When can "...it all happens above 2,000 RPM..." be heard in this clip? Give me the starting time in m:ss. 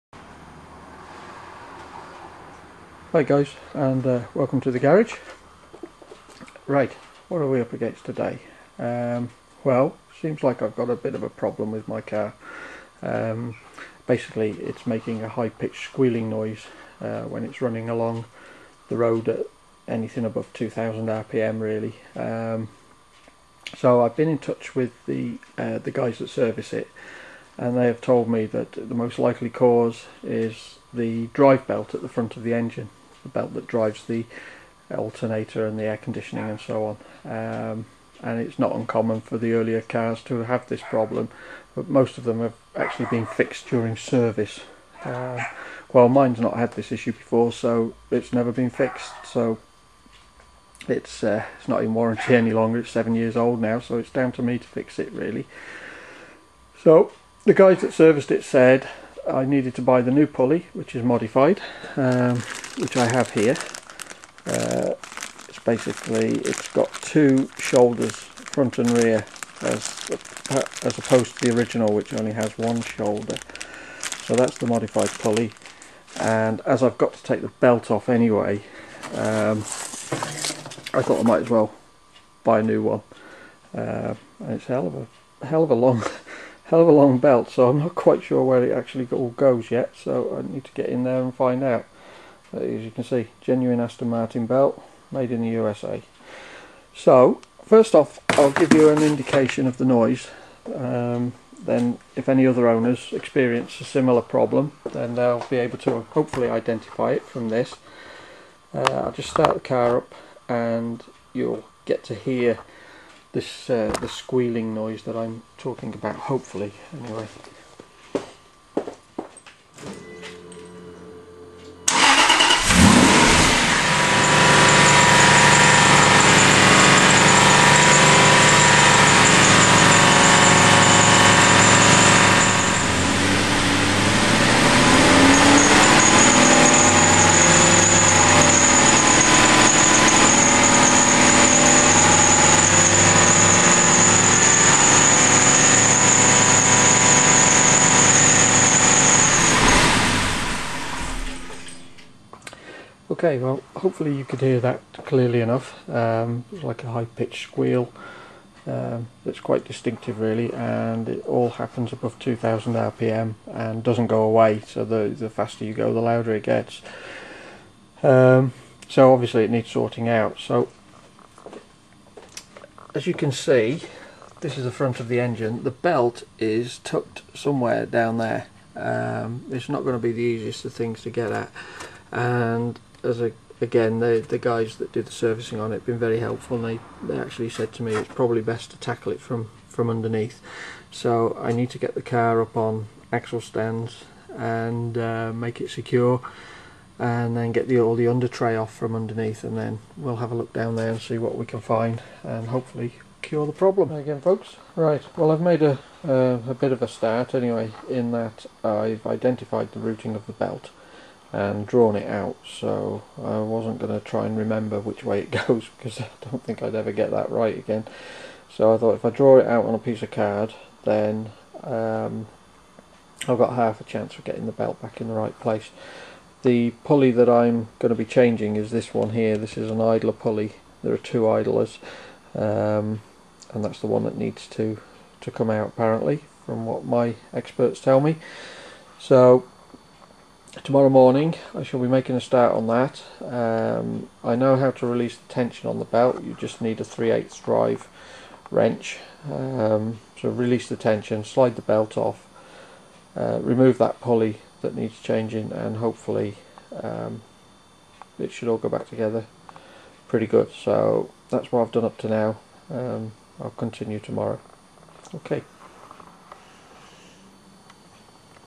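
2:41.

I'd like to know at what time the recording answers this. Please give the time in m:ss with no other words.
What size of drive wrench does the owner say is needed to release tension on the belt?
4:06.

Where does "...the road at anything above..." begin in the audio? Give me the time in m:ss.
0:18.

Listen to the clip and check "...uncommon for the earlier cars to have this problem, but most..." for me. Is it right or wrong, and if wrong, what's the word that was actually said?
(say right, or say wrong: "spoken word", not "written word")
right.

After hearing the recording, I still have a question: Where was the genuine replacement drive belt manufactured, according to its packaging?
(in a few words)
USA.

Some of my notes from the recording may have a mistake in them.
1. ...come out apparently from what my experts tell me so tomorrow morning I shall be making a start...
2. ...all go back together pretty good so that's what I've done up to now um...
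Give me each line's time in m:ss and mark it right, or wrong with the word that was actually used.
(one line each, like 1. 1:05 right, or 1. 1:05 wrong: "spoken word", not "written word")
1. 3:55 right
2. 4:18 right.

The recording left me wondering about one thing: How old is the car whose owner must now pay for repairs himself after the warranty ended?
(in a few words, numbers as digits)
7 years.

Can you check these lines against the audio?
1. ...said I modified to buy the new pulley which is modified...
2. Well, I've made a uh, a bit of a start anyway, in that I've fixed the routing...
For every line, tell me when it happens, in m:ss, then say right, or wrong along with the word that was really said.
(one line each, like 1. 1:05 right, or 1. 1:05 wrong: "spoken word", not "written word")
1. 0:58 wrong: "needed", not "modified"
2. 3:25 wrong: "identified", not "fixed".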